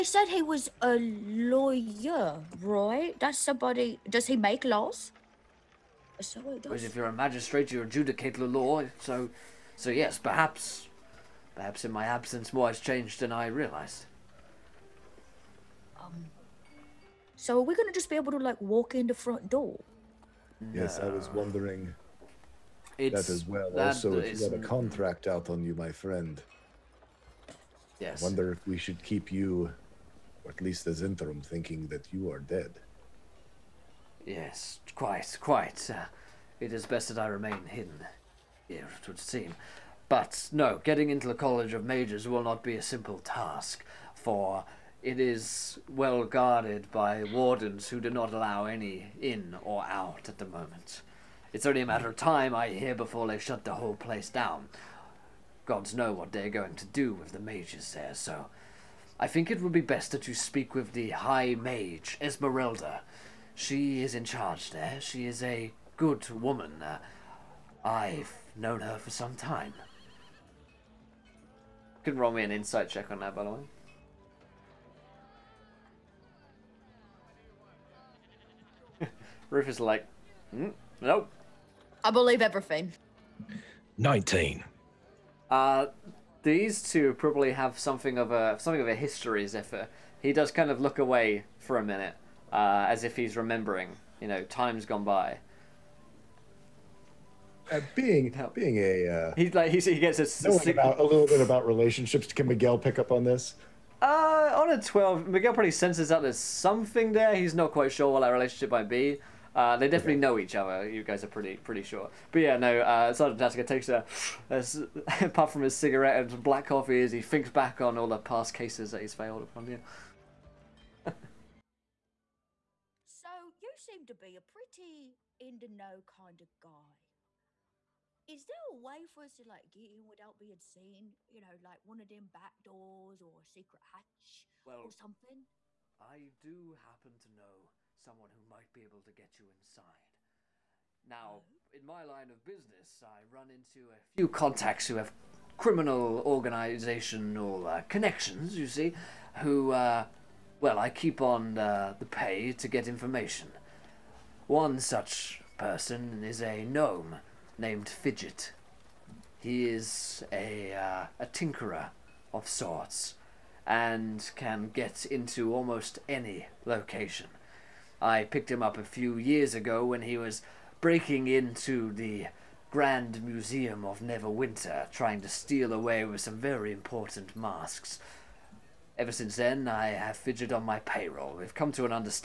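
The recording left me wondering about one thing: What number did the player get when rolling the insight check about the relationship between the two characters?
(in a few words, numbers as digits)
19.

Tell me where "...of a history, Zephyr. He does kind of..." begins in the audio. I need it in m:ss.
1:28.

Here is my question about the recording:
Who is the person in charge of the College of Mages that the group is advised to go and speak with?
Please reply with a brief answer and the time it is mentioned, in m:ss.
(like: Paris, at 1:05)
Esmeralda, at 1:02.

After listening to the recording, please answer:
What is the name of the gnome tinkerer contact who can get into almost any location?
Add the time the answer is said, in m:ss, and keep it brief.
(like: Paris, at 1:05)
Fidget, at 2:37.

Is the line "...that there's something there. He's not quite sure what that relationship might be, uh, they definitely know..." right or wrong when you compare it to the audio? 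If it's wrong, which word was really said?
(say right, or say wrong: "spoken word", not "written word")
right.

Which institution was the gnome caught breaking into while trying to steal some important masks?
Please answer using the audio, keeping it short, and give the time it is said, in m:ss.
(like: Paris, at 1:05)
Grand Museum of Neverwinter, at 2:52.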